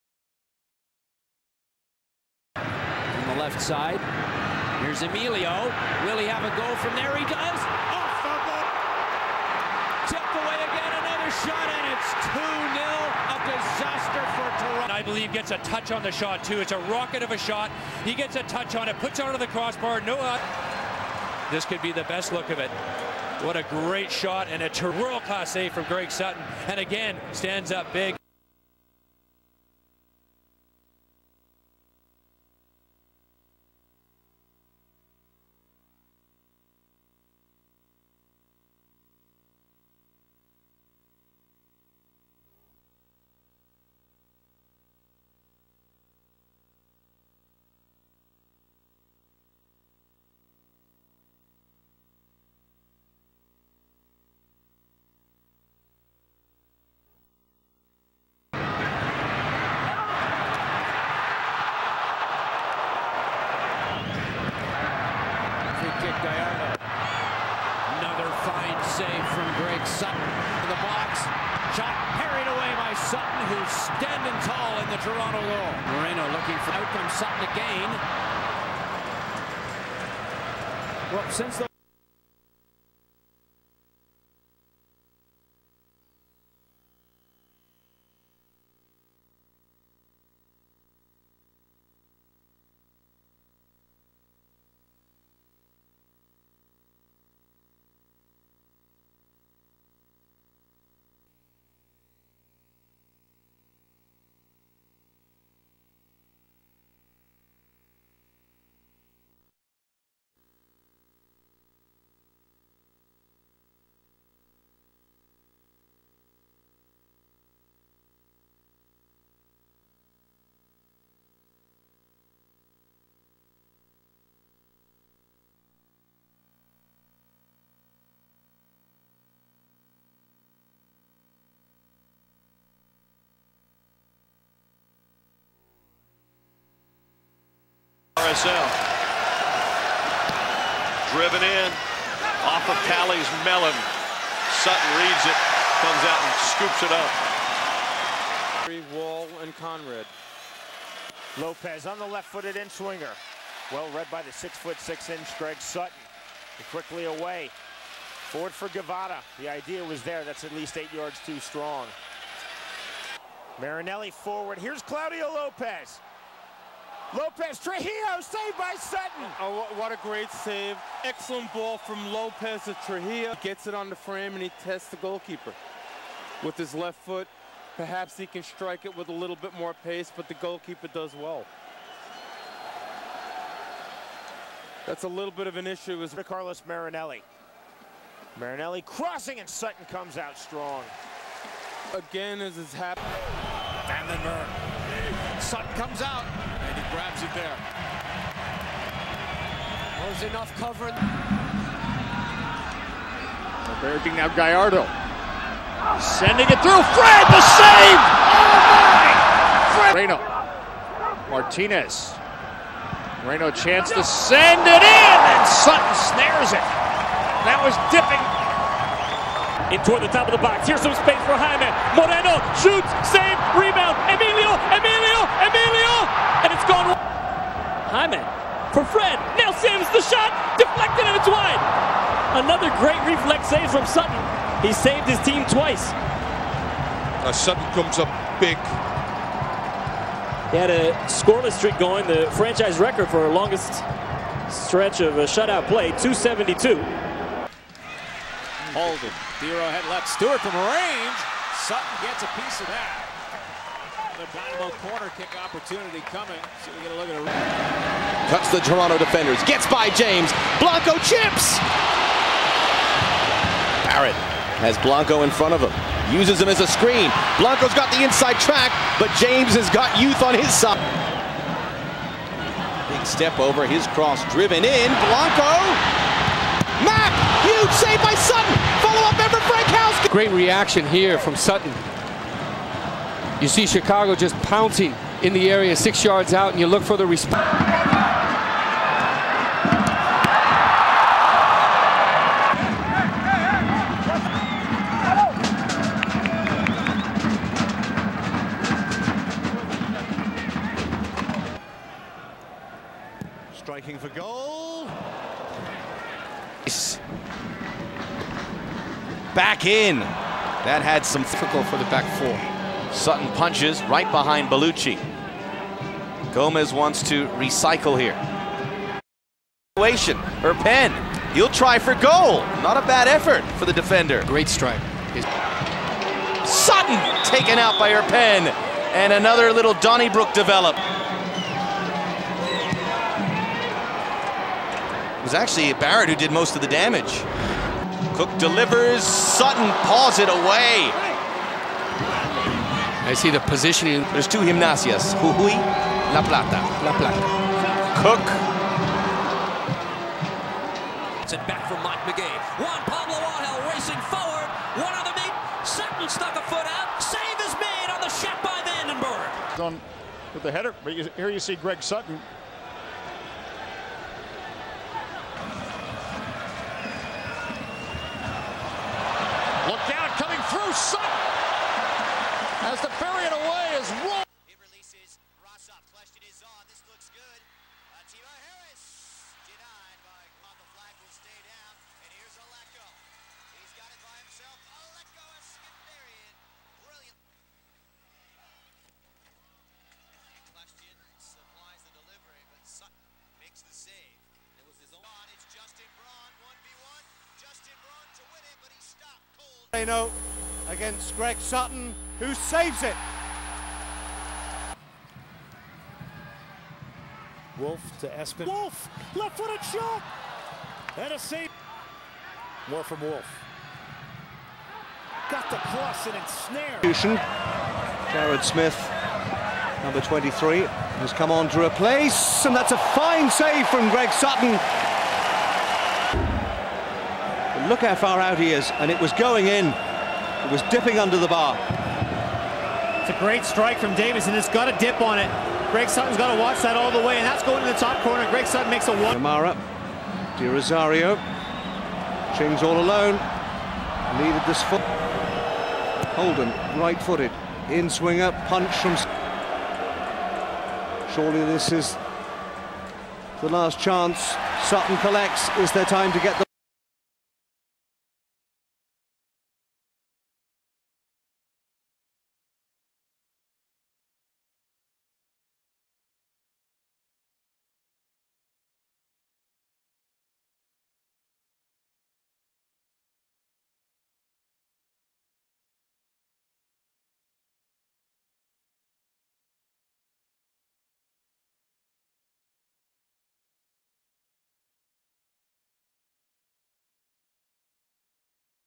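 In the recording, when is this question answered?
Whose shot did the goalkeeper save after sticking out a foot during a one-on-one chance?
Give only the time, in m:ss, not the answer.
5:58.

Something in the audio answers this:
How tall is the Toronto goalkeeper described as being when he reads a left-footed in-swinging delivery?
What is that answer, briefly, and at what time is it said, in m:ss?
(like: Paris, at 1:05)
6 foot 6 inches, at 2:34.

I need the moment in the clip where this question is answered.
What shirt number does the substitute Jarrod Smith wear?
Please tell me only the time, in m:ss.
7:00.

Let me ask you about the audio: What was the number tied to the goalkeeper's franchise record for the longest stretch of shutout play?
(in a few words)
272.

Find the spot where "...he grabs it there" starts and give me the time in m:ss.
3:16.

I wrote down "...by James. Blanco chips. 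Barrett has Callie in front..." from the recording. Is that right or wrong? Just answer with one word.
wrong.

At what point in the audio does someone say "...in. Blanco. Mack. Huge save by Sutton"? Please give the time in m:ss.
4:34.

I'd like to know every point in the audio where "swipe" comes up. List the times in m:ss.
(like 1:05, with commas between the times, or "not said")
not said.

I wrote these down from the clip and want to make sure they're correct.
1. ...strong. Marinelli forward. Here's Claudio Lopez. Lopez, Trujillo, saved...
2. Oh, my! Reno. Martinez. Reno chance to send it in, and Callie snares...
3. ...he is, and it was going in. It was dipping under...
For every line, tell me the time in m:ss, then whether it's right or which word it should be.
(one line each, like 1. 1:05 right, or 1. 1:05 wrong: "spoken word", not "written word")
1. 2:41 right
2. 3:28 wrong: "Sutton", not "Callie"
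3. 7:08 right.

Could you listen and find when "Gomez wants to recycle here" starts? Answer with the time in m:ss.
5:16.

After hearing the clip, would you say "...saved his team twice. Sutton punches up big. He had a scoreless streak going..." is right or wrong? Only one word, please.
wrong.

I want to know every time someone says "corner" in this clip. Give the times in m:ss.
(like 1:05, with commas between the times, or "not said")
4:14, 7:18.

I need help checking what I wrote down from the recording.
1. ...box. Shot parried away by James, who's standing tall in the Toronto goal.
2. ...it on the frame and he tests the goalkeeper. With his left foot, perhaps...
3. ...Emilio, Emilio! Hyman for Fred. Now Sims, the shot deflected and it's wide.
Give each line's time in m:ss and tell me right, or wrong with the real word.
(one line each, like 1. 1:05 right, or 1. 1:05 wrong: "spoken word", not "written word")
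1. 1:10 wrong: "Sutton", not "James"
2. 2:53 right
3. 3:44 right.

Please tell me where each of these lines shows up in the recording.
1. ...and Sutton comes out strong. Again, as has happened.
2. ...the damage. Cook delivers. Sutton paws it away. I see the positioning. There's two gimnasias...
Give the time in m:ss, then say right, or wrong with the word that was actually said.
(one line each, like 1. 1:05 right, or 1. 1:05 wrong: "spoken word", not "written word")
1. 3:09 right
2. 5:36 right.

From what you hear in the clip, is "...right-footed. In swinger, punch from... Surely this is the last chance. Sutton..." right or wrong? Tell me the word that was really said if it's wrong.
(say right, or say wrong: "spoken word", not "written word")
right.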